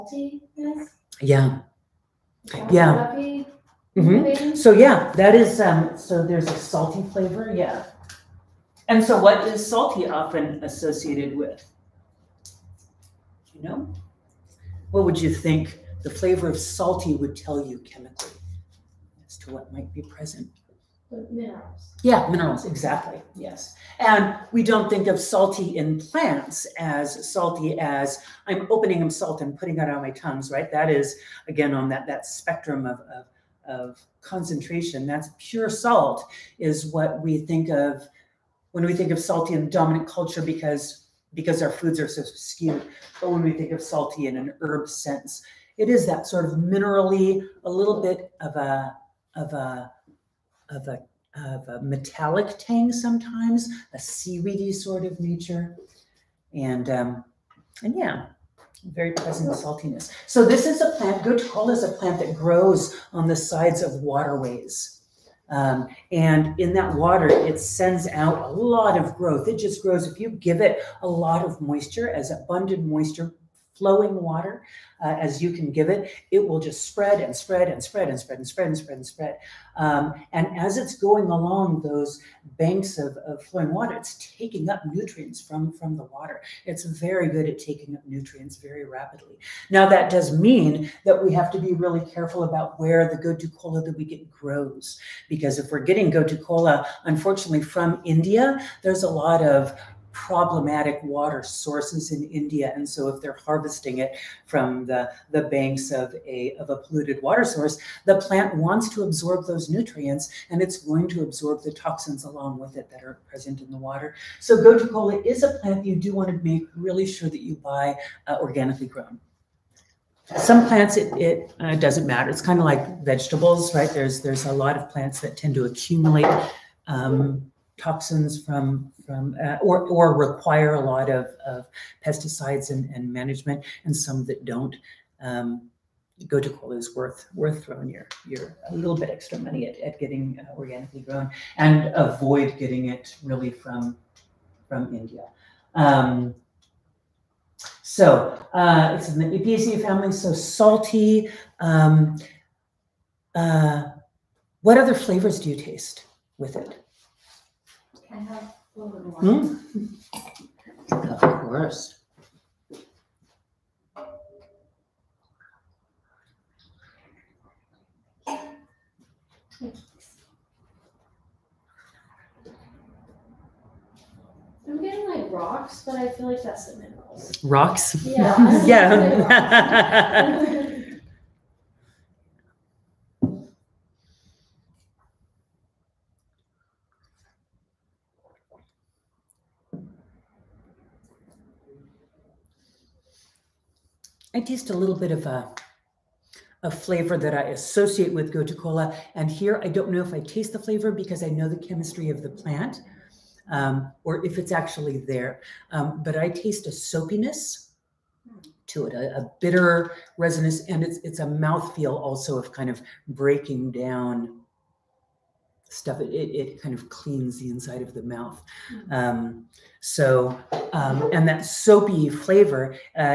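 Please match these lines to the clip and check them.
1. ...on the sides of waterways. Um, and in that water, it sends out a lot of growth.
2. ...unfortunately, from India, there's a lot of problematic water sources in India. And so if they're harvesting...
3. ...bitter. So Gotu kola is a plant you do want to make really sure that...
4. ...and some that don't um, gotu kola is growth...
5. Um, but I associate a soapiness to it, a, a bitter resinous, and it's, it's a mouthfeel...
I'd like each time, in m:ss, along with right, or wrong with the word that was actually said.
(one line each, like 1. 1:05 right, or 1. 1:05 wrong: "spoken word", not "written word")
1. 1:03 right
2. 1:37 right
3. 1:53 wrong: "water", not "bitter"
4. 2:13 wrong: "worth", not "growth"
5. 3:25 wrong: "taste", not "associate".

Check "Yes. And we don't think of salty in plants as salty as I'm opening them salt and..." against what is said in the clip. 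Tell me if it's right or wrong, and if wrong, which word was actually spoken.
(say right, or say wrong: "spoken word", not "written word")
right.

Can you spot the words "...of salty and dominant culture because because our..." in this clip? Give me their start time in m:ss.
0:39.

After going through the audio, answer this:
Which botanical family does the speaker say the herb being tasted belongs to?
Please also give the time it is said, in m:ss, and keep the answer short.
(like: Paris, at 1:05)
Apiaceae, at 2:29.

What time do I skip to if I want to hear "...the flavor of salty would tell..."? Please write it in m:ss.
0:16.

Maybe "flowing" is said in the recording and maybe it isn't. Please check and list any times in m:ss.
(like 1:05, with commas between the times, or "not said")
1:13, 1:23.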